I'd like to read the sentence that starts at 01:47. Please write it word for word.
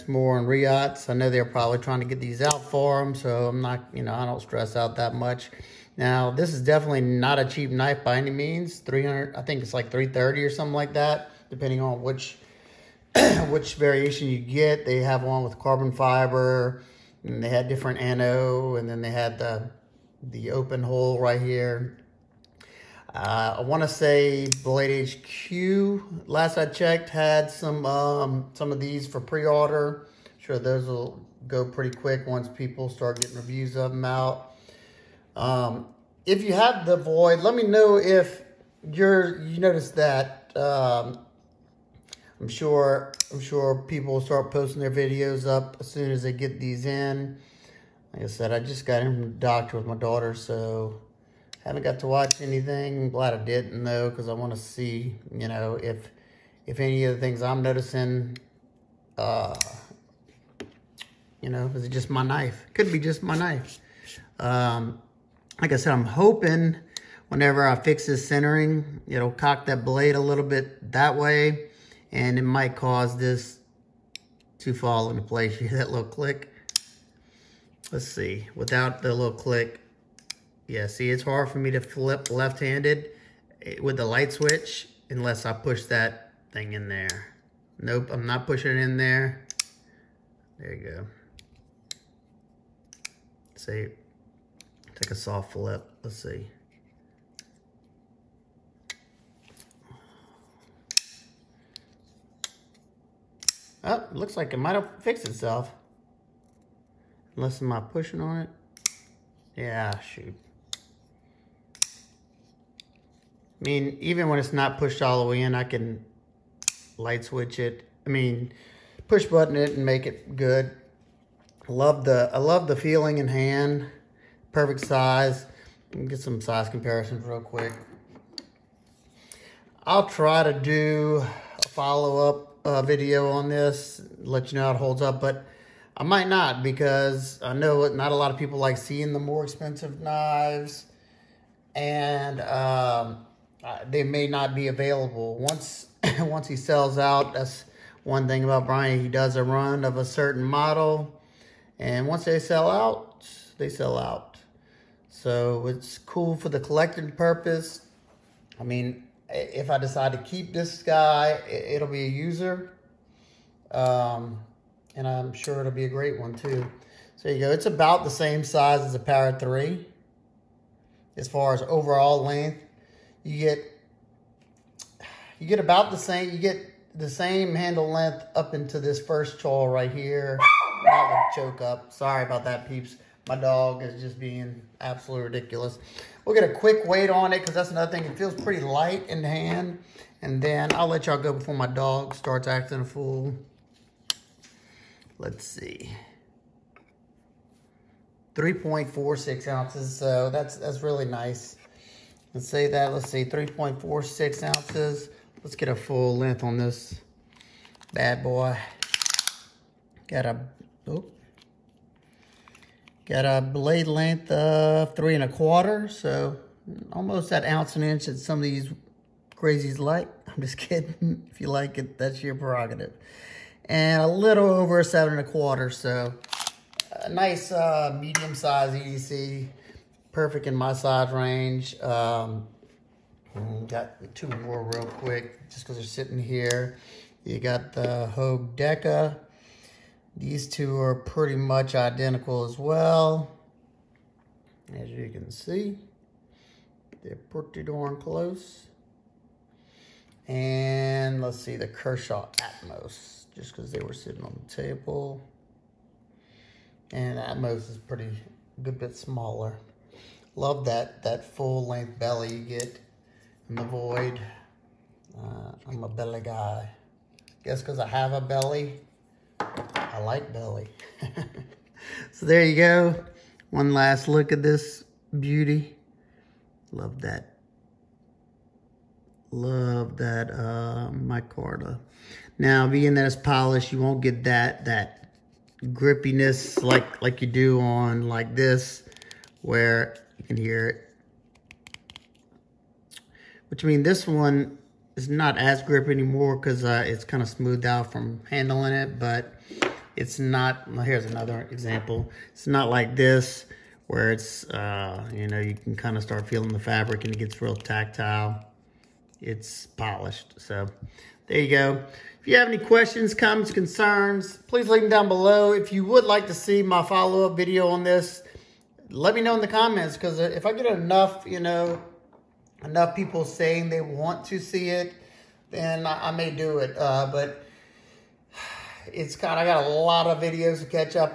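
Unless am I pushing on it?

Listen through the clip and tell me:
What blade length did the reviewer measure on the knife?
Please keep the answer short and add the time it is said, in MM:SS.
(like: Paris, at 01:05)
3 and a quarter inches, at 03:34.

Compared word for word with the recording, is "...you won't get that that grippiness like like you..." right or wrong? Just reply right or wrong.
right.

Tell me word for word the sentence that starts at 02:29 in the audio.
He does a run of a certain model, and once they sell out, they sell out.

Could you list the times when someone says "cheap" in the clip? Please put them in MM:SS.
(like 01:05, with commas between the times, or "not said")
00:07.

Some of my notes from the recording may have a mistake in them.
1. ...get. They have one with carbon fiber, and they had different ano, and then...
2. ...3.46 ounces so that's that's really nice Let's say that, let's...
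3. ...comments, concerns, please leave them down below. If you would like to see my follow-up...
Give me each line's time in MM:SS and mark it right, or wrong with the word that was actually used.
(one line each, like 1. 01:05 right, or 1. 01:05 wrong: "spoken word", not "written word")
1. 00:14 right
2. 03:18 right
3. 05:13 right.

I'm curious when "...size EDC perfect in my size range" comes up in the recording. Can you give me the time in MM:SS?
03:48.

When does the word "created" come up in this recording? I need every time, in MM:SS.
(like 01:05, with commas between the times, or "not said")
not said.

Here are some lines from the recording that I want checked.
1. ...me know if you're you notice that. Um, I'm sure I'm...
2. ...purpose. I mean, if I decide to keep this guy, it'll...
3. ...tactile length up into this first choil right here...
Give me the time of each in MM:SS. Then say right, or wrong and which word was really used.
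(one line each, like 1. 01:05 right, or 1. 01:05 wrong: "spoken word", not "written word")
1. 00:37 right
2. 02:37 right
3. 02:57 wrong: "handle", not "tactile".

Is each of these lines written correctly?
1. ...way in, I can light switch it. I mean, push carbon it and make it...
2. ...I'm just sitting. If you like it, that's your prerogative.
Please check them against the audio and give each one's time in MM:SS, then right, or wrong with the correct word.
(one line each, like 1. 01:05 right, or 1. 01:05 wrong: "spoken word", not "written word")
1. 01:55 wrong: "button", not "carbon"
2. 03:40 wrong: "kidding", not "sitting".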